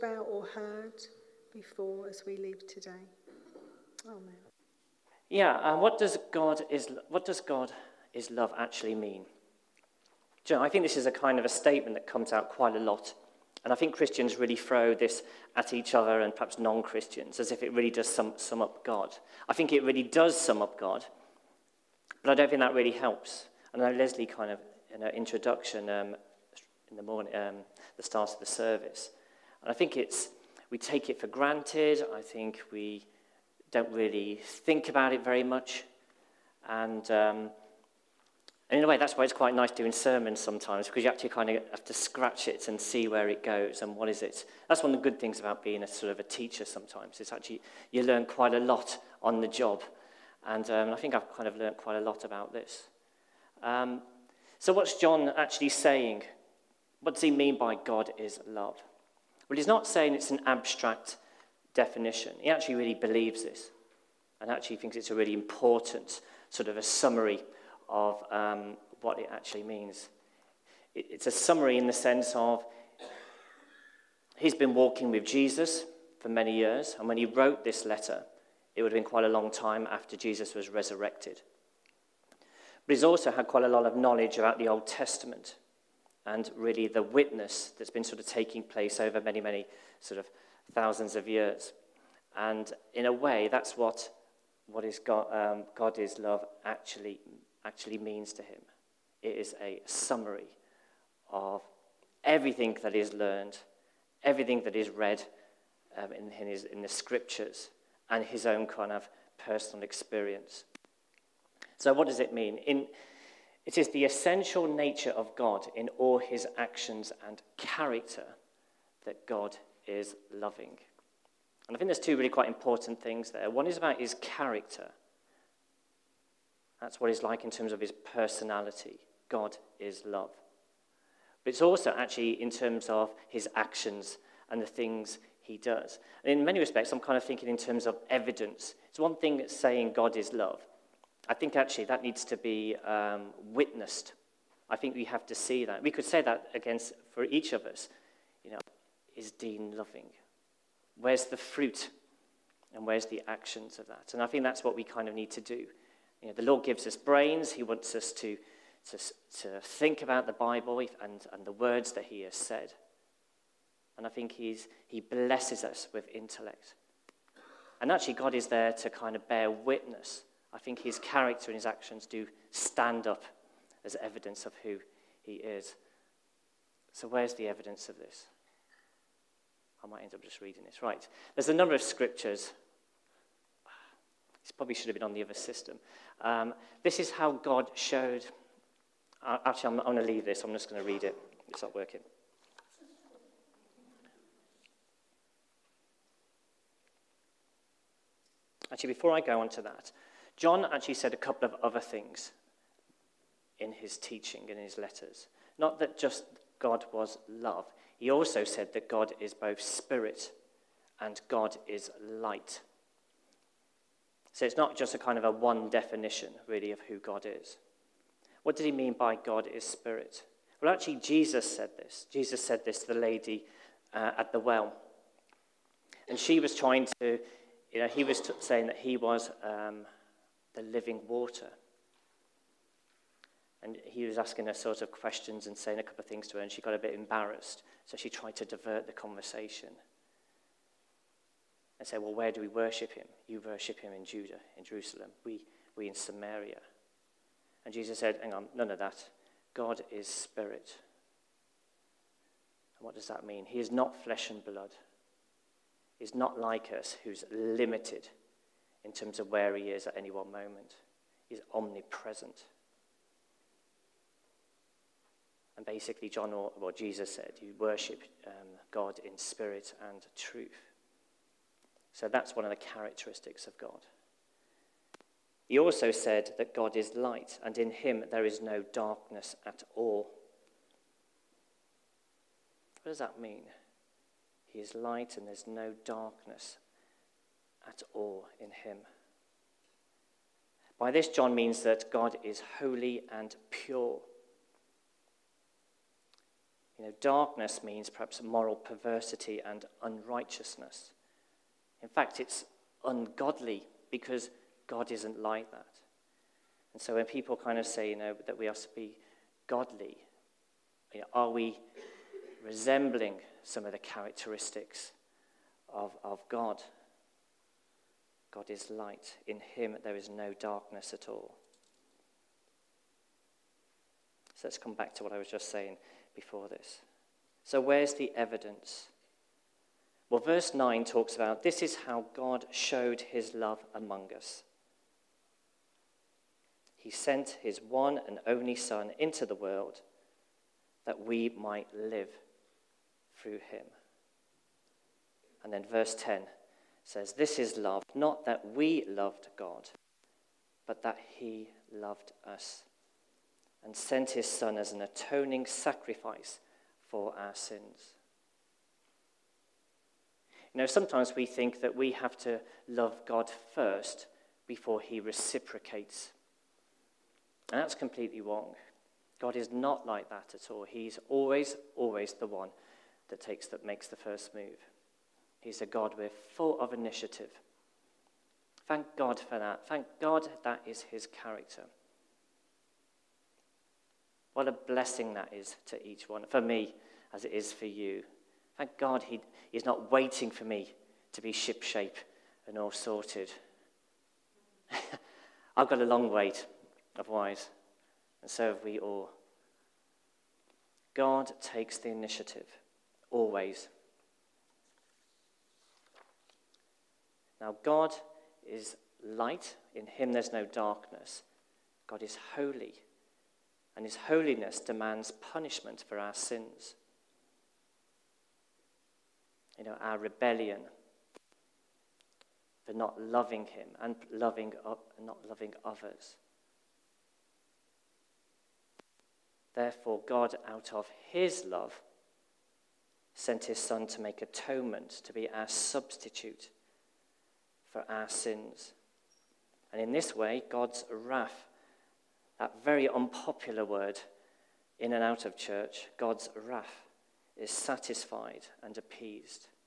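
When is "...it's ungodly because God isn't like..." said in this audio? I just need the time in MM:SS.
05:02.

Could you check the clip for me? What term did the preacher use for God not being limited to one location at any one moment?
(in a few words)
Omnipresent.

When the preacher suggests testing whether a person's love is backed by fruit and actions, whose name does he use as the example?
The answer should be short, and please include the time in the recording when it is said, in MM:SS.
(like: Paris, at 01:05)
Dean, at 02:29.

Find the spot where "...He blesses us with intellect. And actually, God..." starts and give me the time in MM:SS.
02:44.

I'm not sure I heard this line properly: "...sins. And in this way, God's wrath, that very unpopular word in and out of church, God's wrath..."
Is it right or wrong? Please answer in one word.
right.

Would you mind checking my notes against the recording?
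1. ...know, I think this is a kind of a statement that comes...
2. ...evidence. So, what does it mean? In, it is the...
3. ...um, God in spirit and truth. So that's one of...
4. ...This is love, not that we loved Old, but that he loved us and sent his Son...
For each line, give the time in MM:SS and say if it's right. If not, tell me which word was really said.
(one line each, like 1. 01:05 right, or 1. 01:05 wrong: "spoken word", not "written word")
1. 00:10 right
2. 01:49 wrong: "experience", not "evidence"
3. 04:28 right
4. 05:47 wrong: "God", not "Old".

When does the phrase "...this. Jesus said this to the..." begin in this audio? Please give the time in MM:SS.
03:41.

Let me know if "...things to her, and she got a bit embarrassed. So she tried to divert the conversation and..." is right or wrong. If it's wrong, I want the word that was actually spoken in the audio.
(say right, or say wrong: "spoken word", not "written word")
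right.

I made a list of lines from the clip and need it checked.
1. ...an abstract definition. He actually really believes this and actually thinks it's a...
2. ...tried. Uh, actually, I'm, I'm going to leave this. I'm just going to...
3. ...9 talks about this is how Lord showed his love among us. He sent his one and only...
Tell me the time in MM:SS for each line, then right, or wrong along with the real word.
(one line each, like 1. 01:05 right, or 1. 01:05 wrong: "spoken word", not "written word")
1. 01:00 right
2. 03:07 wrong: "showed", not "tried"
3. 05:30 wrong: "God", not "Lord".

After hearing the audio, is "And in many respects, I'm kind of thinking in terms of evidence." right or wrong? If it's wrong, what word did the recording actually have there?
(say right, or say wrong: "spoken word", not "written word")
right.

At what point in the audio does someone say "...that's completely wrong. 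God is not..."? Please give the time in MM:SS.
06:07.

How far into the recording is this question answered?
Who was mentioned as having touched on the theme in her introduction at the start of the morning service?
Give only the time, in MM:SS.
00:23.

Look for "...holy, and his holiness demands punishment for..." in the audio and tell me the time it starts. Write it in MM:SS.
06:52.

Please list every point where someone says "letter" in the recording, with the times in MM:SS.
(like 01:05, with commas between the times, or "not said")
01:17, 03:24.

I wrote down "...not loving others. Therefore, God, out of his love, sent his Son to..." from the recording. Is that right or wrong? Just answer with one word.
right.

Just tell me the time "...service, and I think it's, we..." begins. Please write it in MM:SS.
00:28.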